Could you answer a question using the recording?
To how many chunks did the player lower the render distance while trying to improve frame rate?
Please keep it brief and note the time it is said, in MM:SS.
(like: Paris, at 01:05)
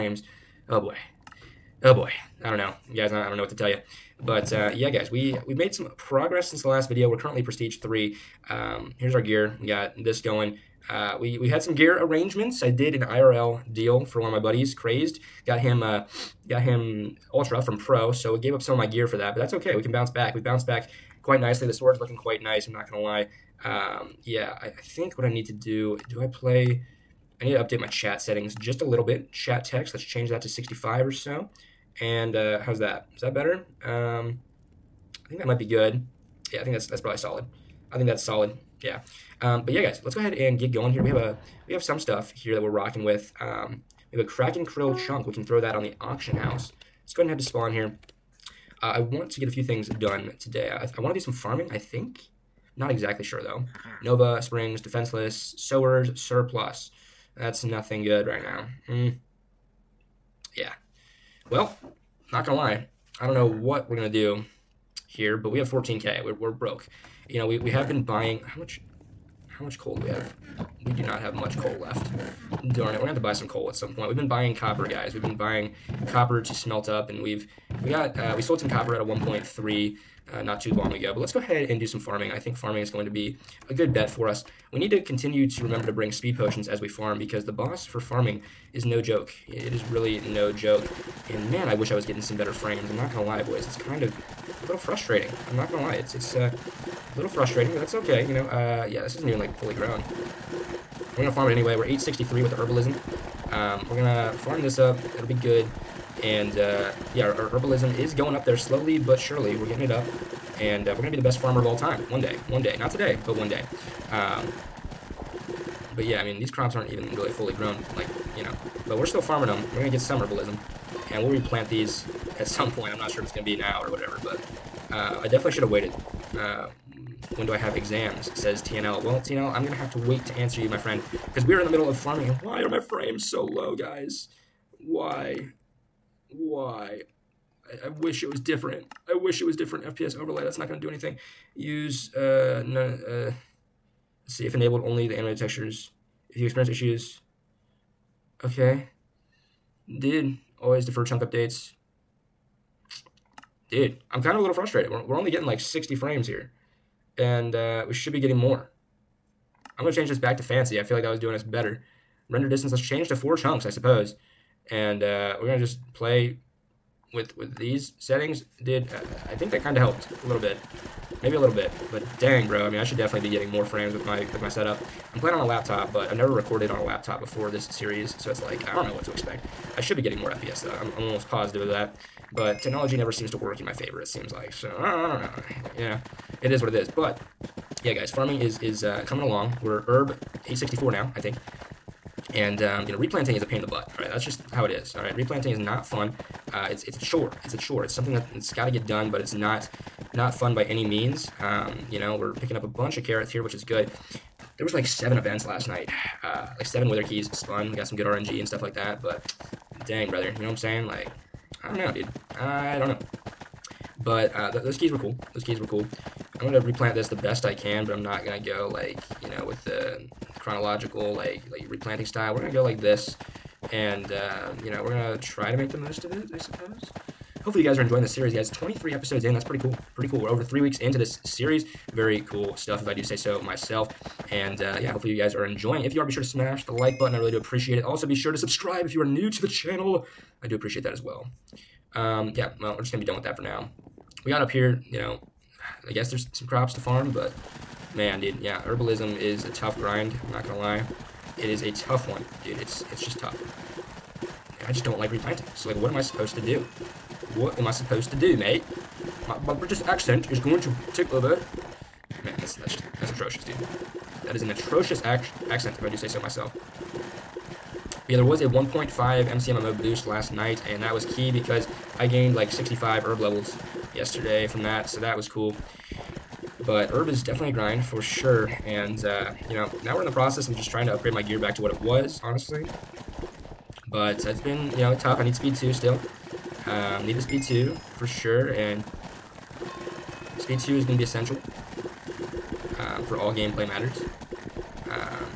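4, at 02:43.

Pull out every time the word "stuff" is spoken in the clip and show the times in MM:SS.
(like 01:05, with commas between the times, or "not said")
00:41, 03:28, 03:52.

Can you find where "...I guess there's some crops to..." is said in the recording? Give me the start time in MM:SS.
04:05.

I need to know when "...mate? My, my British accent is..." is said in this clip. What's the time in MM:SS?
04:18.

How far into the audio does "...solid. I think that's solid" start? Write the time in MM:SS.
00:37.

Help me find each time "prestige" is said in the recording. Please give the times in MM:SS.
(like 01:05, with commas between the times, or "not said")
00:07.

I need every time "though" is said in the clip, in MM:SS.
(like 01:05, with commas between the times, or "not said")
00:53, 03:00.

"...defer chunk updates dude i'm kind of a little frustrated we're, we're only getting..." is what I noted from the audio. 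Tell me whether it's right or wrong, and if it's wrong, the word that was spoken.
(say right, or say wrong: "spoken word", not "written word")
right.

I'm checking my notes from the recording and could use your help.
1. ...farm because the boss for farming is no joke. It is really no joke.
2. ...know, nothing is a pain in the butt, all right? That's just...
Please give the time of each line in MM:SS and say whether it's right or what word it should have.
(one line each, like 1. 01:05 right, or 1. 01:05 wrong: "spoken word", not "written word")
1. 01:26 right
2. 03:12 wrong: "replanting", not "nothing".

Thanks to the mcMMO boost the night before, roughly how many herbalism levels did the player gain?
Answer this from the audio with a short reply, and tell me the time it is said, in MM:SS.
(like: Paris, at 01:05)
65, at 04:32.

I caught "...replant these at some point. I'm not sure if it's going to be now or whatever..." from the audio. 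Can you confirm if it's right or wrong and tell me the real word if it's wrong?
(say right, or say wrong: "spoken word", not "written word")
right.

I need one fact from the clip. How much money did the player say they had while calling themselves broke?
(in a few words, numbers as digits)
14k.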